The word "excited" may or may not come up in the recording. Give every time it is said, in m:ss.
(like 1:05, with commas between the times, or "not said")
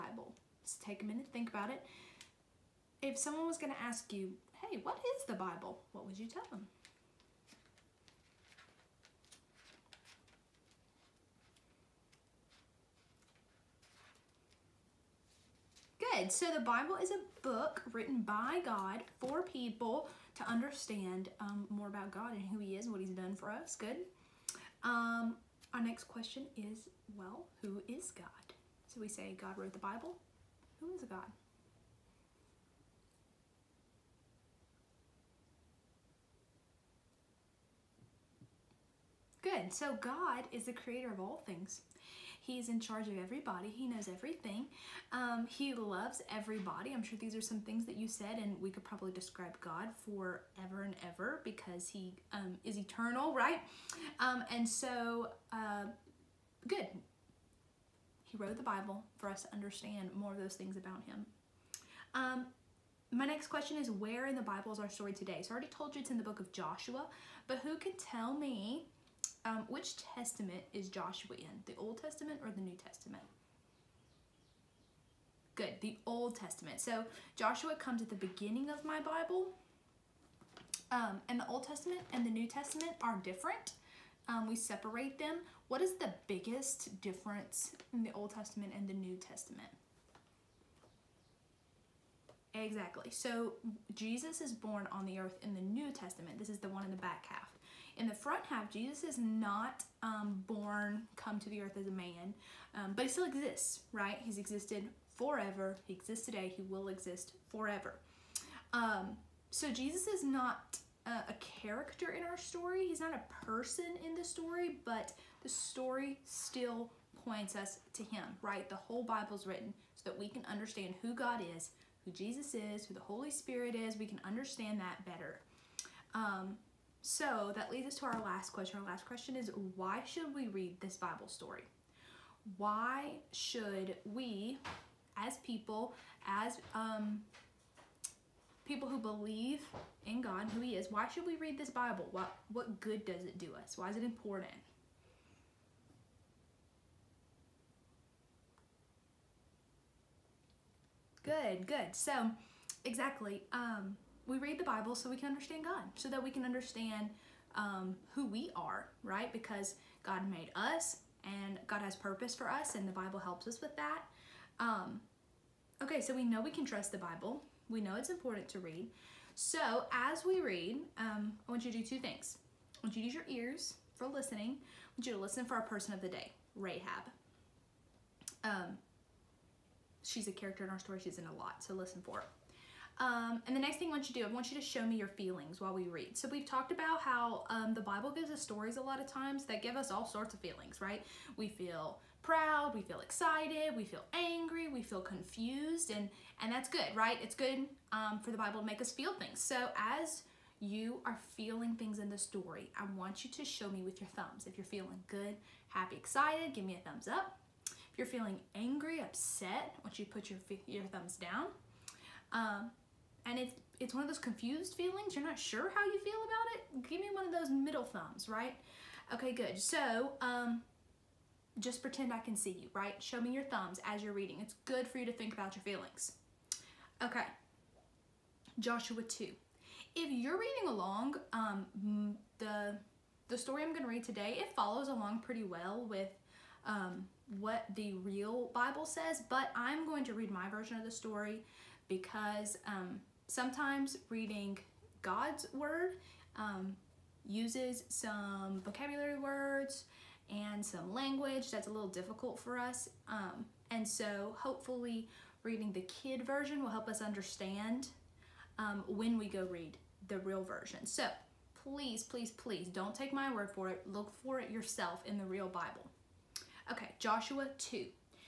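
3:12, 3:25.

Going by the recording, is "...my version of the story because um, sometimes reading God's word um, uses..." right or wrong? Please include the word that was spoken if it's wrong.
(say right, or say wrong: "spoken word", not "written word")
right.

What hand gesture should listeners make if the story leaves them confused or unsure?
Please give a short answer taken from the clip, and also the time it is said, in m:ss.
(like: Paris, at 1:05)
middle thumbs, at 3:37.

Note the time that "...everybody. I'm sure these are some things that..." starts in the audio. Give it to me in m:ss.
0:46.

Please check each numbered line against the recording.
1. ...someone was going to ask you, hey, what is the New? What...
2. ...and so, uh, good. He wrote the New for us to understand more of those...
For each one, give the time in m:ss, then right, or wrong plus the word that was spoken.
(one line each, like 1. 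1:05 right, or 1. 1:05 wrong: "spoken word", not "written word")
1. 0:03 wrong: "Bible", not "New"
2. 0:54 wrong: "Bible", not "New".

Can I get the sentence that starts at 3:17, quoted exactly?
It's good um, for the Bible to make us feel things.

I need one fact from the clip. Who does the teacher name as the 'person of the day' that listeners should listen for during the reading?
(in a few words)
Rahab.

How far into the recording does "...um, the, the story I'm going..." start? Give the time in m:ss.
3:51.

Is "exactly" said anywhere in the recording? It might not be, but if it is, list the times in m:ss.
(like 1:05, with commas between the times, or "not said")
1:32, 2:32.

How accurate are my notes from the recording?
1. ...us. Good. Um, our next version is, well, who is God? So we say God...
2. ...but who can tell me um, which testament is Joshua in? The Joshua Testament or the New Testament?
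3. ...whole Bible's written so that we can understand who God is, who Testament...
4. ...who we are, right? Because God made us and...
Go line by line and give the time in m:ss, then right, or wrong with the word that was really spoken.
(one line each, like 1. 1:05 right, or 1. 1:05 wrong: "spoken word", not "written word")
1. 0:23 wrong: "question", not "version"
2. 1:07 wrong: "Old", not "Joshua"
3. 1:58 wrong: "Jesus", not "Testament"
4. 2:38 right.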